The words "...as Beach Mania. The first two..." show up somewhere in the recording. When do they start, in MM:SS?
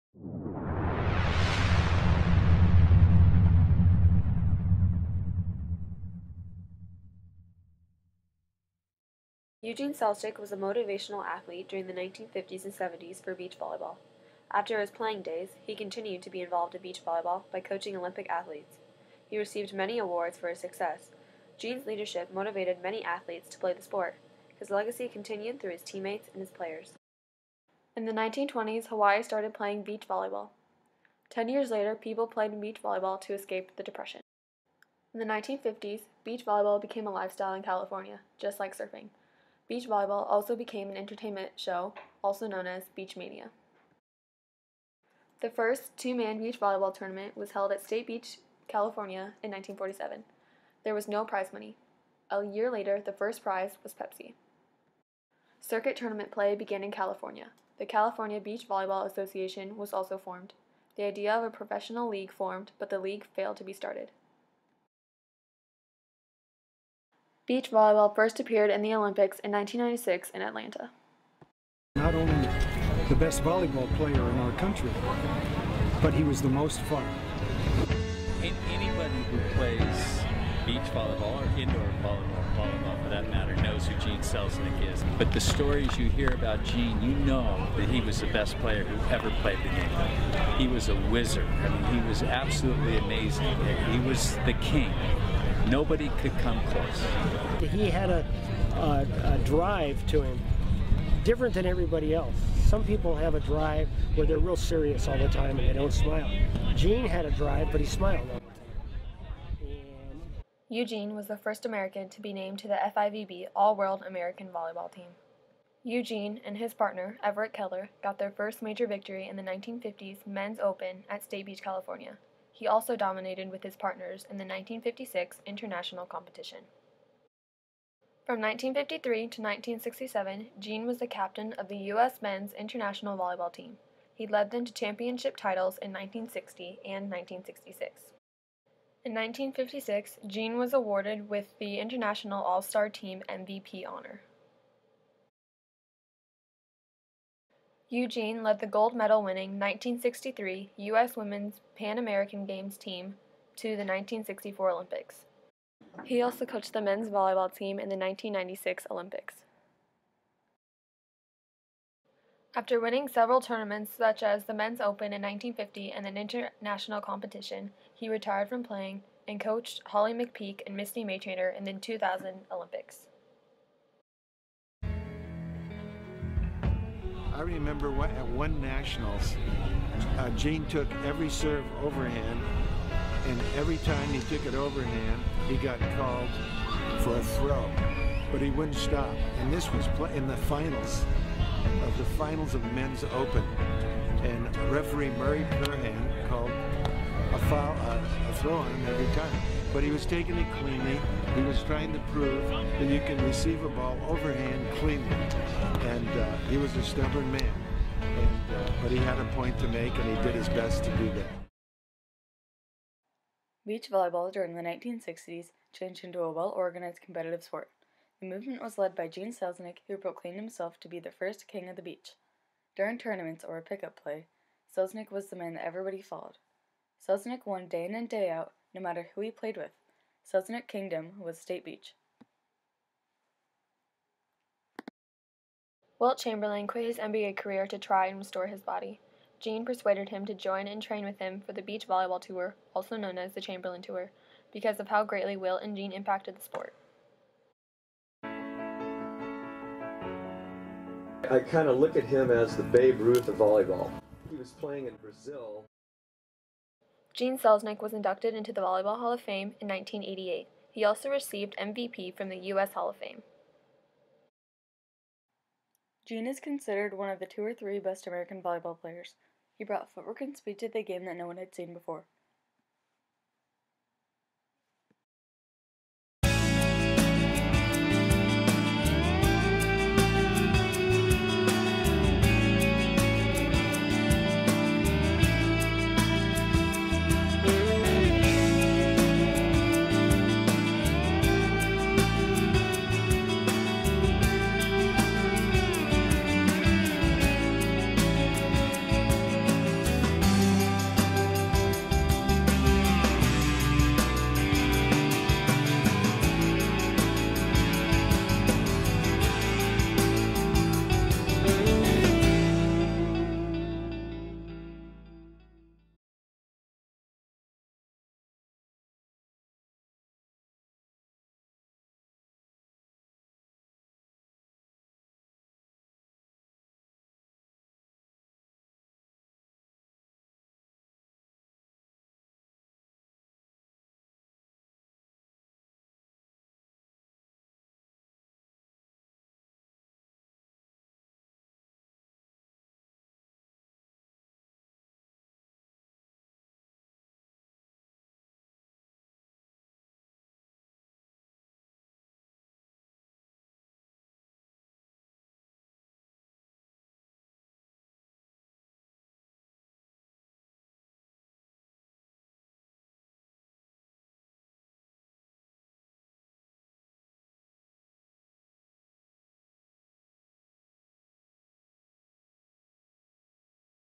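00:42.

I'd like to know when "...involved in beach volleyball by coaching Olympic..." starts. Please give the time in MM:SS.
00:16.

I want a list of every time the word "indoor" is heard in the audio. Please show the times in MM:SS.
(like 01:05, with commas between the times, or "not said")
01:21.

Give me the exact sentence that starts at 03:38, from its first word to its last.
The movement was led by Gene Selznick, who proclaimed himself to be the first king of the beach.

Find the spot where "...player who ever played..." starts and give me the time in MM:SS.
01:28.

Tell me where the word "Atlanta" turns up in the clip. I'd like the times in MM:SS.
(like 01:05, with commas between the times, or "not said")
01:10.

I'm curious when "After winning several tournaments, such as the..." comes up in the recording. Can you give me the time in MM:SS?
02:42.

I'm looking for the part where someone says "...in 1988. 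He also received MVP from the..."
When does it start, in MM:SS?
04:19.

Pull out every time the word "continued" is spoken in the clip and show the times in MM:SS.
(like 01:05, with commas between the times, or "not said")
00:15, 00:25.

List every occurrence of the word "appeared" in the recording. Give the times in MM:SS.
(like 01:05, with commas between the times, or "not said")
01:08.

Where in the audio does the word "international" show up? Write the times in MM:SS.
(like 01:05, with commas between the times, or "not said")
02:05, 02:12, 02:21, 02:46.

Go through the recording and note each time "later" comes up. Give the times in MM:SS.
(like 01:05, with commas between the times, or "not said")
00:31, 00:52.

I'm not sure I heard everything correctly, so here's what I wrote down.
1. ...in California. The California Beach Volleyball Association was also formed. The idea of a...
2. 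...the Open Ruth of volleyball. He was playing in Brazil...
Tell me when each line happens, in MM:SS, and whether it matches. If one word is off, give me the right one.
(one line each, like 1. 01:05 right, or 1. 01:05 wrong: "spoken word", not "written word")
1. 00:56 right
2. 04:12 wrong: "Babe", not "Open".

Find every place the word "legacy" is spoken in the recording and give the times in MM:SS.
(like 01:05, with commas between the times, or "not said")
00:24.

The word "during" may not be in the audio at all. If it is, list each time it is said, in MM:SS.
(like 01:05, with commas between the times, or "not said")
00:11, 03:34, 03:42.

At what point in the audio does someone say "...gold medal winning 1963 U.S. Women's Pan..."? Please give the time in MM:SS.
02:28.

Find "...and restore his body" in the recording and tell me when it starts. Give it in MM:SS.
03:58.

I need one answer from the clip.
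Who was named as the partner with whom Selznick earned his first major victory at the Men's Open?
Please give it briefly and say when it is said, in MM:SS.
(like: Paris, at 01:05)
Everett Keller, at 01:57.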